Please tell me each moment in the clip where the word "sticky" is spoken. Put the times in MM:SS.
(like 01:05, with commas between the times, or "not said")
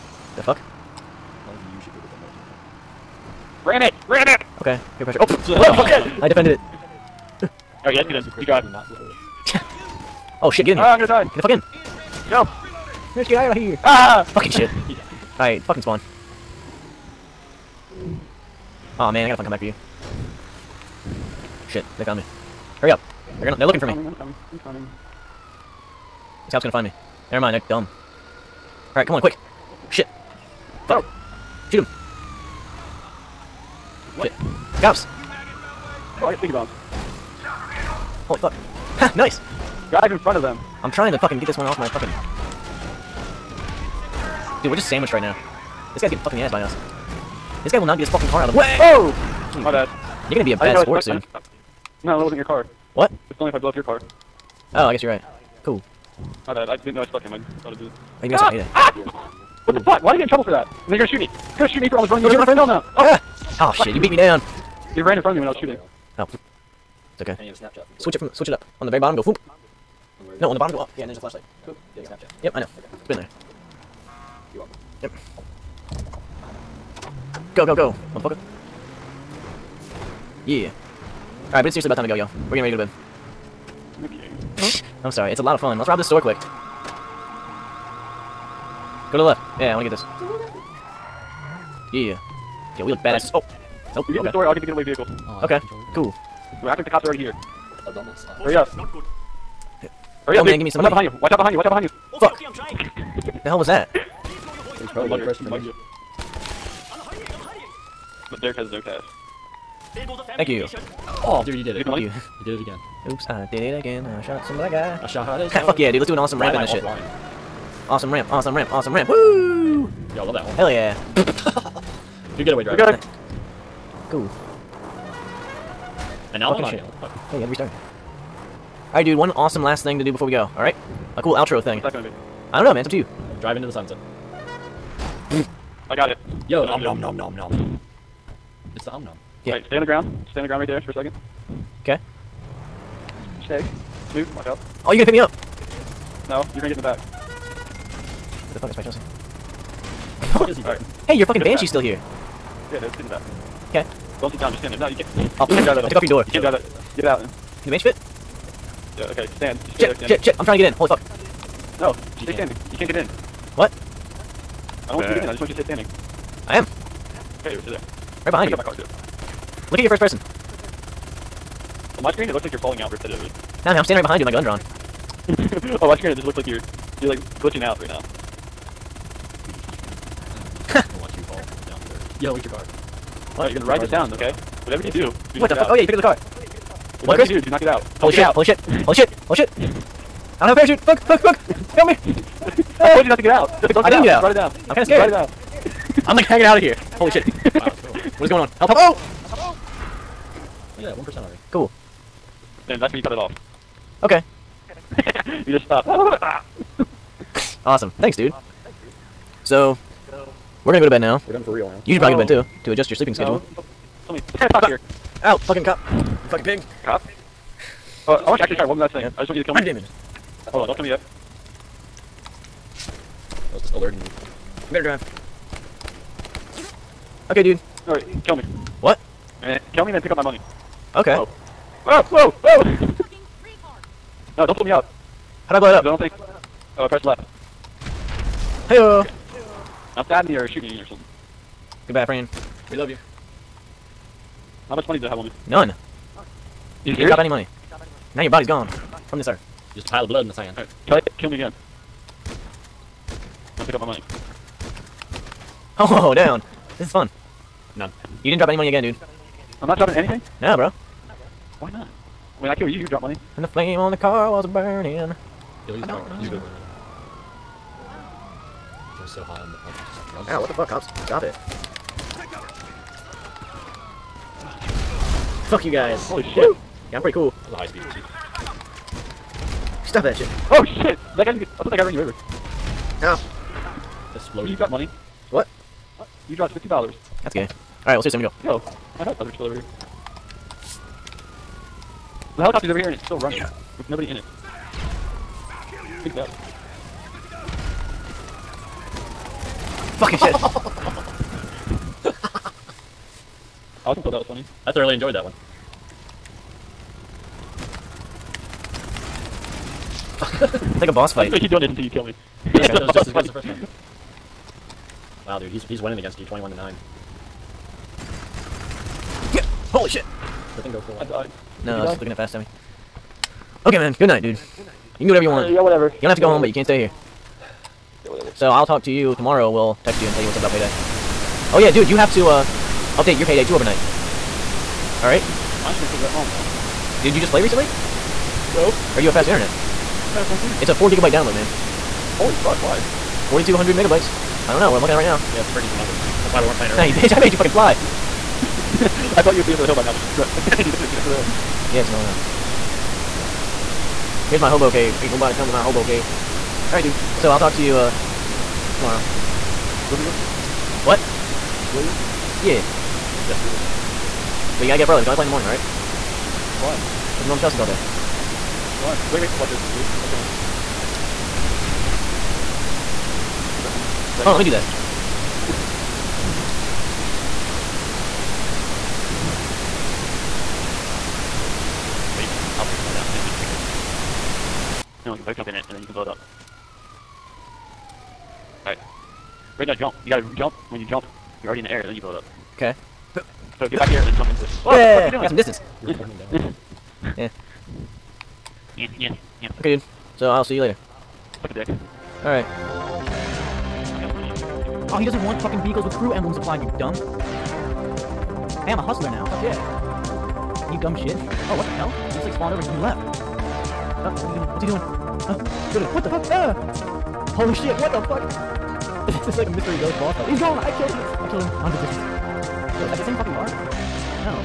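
00:36.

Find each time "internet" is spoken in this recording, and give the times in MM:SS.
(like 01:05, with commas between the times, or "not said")
05:39.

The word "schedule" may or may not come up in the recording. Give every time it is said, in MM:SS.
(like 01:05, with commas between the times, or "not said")
03:33.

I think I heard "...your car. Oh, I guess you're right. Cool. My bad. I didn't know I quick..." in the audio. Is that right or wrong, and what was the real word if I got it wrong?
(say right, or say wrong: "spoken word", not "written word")
wrong: "stuck", not "quick".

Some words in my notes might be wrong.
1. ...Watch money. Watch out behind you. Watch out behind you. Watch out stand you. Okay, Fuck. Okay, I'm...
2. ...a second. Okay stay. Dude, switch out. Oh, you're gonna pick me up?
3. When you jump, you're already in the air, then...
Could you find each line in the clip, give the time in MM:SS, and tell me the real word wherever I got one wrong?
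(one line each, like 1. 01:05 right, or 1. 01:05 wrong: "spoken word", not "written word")
1. 01:40 wrong: "behind", not "stand"
2. 02:20 wrong: "watch", not "switch"
3. 06:30 right.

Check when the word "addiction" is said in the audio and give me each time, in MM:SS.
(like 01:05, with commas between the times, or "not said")
not said.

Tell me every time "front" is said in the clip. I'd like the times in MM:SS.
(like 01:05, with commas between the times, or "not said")
00:40, 01:05.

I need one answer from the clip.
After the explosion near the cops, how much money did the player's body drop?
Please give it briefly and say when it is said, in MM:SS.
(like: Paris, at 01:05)
$50, at 04:46.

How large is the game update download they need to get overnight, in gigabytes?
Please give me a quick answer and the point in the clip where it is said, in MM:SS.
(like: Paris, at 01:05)
4 gigabytes, at 05:40.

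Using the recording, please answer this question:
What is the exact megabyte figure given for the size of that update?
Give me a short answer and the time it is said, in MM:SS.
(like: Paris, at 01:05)
4,200 megabytes, at 05:43.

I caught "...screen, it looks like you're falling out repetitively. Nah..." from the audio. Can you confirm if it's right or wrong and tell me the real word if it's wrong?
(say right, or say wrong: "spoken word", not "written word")
right.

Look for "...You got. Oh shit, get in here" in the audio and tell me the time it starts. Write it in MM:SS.
00:08.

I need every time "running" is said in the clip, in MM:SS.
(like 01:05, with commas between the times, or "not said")
01:02, 04:53.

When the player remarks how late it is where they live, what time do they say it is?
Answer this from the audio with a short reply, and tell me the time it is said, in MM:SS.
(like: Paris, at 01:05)
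10 o'clock, at 03:34.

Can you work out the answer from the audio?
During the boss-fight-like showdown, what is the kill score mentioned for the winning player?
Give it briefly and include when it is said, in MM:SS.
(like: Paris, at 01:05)
21 to 9, at 05:16.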